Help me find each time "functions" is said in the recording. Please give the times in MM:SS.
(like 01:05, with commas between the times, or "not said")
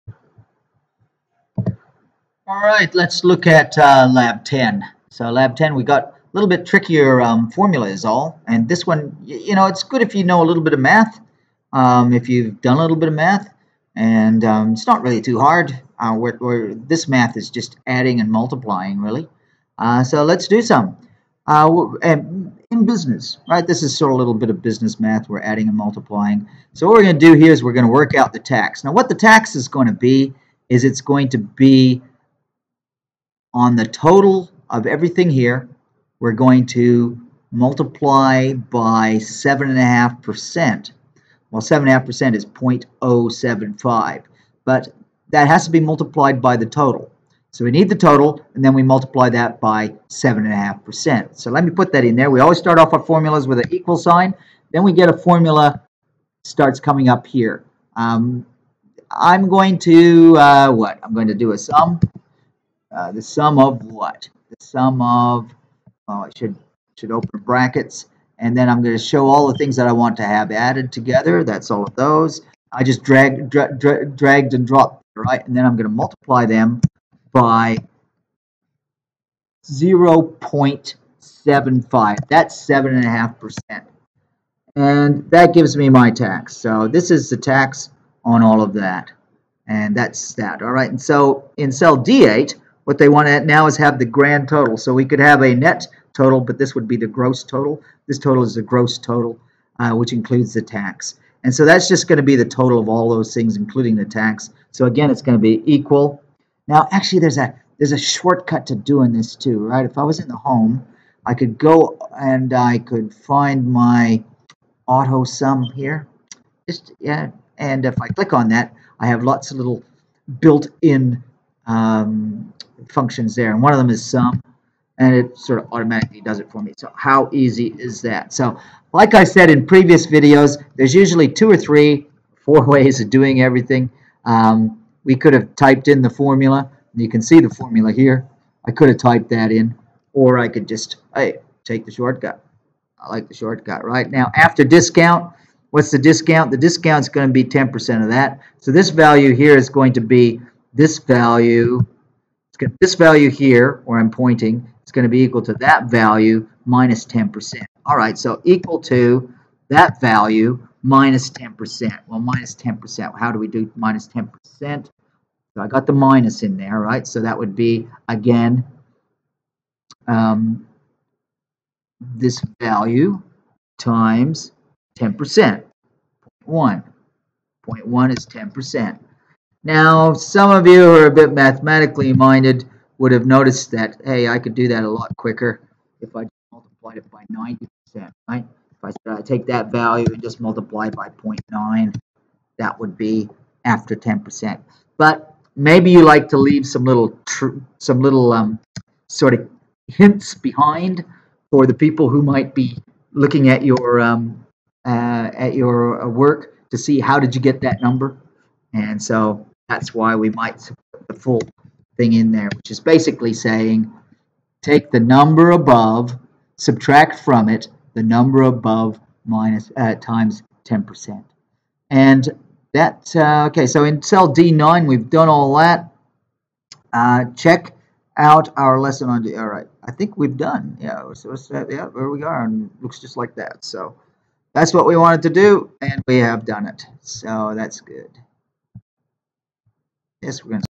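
02:02.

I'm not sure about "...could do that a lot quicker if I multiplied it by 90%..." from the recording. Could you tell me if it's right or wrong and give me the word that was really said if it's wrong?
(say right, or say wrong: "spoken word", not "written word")
right.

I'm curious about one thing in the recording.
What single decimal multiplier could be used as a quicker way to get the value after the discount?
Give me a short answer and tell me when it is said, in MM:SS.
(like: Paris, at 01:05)
0.9, at 03:11.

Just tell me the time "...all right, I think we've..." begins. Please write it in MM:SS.
03:49.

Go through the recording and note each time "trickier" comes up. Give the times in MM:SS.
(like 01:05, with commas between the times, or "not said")
00:06.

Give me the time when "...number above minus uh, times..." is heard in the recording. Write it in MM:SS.
03:38.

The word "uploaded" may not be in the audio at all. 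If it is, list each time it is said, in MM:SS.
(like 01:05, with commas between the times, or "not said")
not said.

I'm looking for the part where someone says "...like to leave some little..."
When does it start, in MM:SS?
03:16.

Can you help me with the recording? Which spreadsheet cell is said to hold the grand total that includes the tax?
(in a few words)
D8.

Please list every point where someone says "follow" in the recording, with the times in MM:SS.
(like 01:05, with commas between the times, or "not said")
not said.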